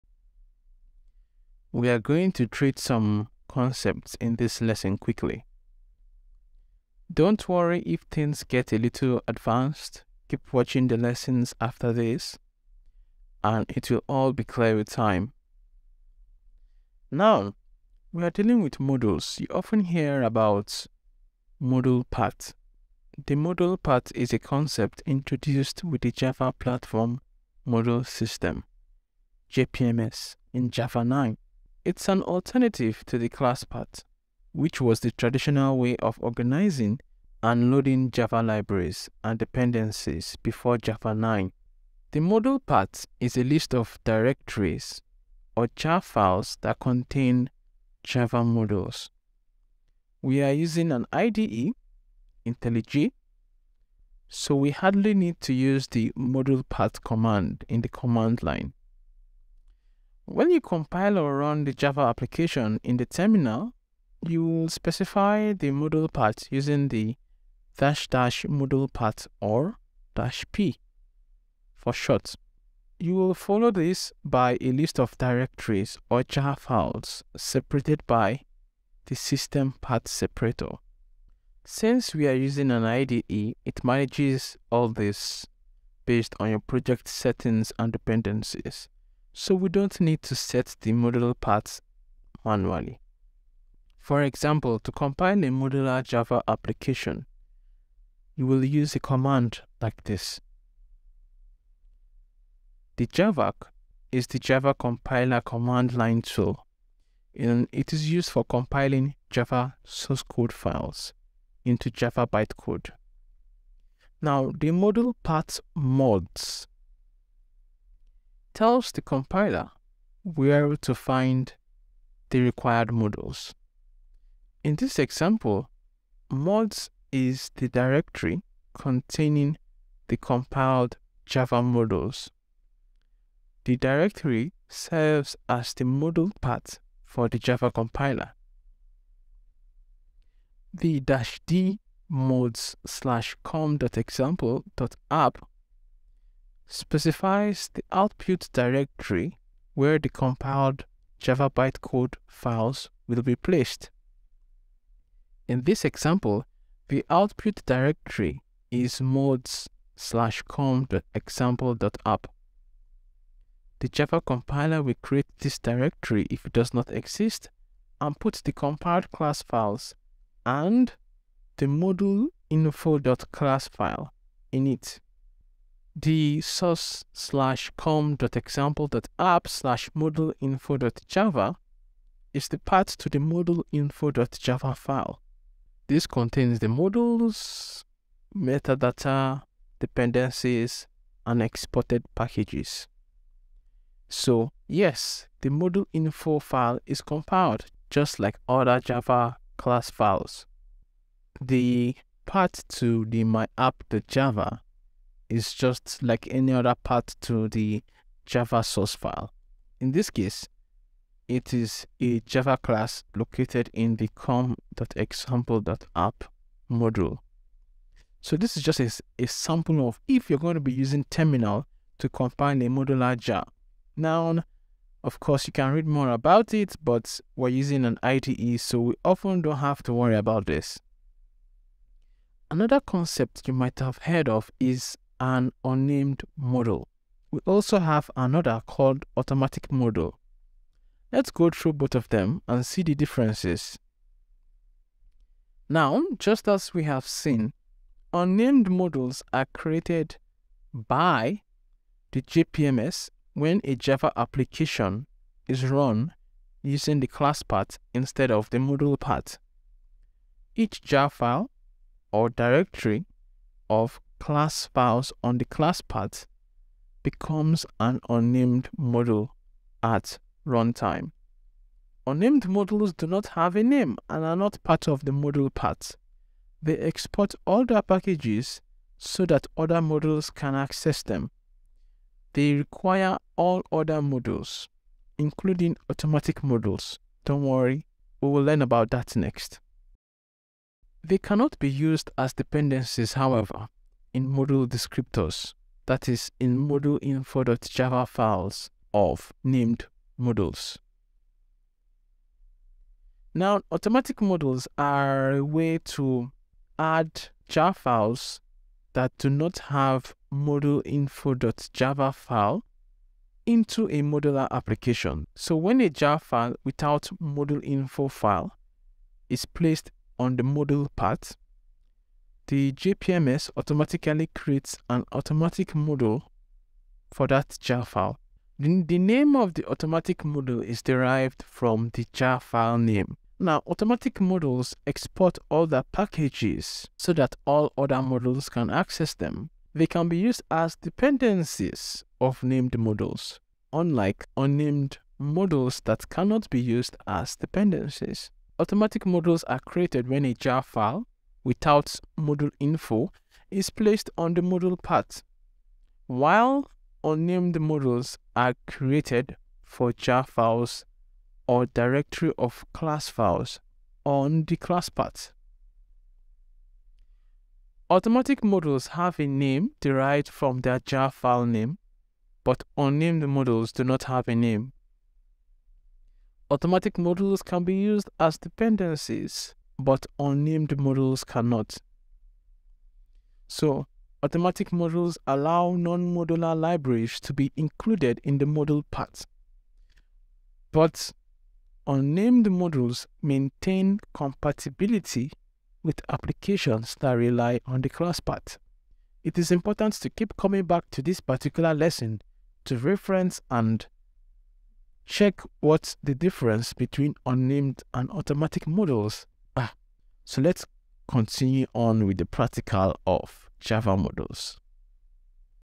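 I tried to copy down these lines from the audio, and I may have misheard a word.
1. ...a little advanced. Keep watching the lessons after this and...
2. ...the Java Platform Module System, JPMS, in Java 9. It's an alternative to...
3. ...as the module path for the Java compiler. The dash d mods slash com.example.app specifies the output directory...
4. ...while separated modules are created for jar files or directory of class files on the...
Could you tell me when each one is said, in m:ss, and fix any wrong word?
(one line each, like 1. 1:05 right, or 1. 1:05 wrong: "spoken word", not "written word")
1. 0:08 right
2. 0:26 right
3. 2:15 right
4. 5:56 wrong: "unnamed", not "separated".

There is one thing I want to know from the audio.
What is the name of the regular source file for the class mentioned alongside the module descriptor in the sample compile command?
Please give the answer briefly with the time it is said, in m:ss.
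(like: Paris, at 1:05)
myapp.java, at 3:23.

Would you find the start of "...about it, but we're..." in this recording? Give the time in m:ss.
3:46.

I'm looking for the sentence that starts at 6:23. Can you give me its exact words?
So, automatic modules allow non-modular libraries to be included in the module path.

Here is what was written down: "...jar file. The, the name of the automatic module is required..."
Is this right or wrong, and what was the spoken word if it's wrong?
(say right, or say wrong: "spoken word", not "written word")
wrong: "derived", not "required".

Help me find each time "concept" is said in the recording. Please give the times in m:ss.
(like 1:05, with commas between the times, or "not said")
0:03, 0:24, 3:52.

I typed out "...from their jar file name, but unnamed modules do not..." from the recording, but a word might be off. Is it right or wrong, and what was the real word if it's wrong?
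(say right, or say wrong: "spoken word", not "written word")
right.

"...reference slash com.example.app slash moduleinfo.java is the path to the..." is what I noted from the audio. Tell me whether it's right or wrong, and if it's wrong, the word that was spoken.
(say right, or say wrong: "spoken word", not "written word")
wrong: "source", not "reference".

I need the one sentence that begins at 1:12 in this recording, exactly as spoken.
You will follow this by a list of directories or jar files separated by the system path separator.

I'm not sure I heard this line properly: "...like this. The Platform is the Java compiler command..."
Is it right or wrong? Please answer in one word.
wrong.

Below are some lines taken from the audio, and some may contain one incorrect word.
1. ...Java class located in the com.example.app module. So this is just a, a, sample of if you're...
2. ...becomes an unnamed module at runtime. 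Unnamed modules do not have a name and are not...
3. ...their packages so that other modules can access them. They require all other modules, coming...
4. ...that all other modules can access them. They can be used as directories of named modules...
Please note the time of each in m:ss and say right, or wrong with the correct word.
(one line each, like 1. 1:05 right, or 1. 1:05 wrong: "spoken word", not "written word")
1. 3:32 right
2. 4:27 right
3. 4:37 wrong: "including", not "coming"
4. 5:37 wrong: "dependencies", not "directories".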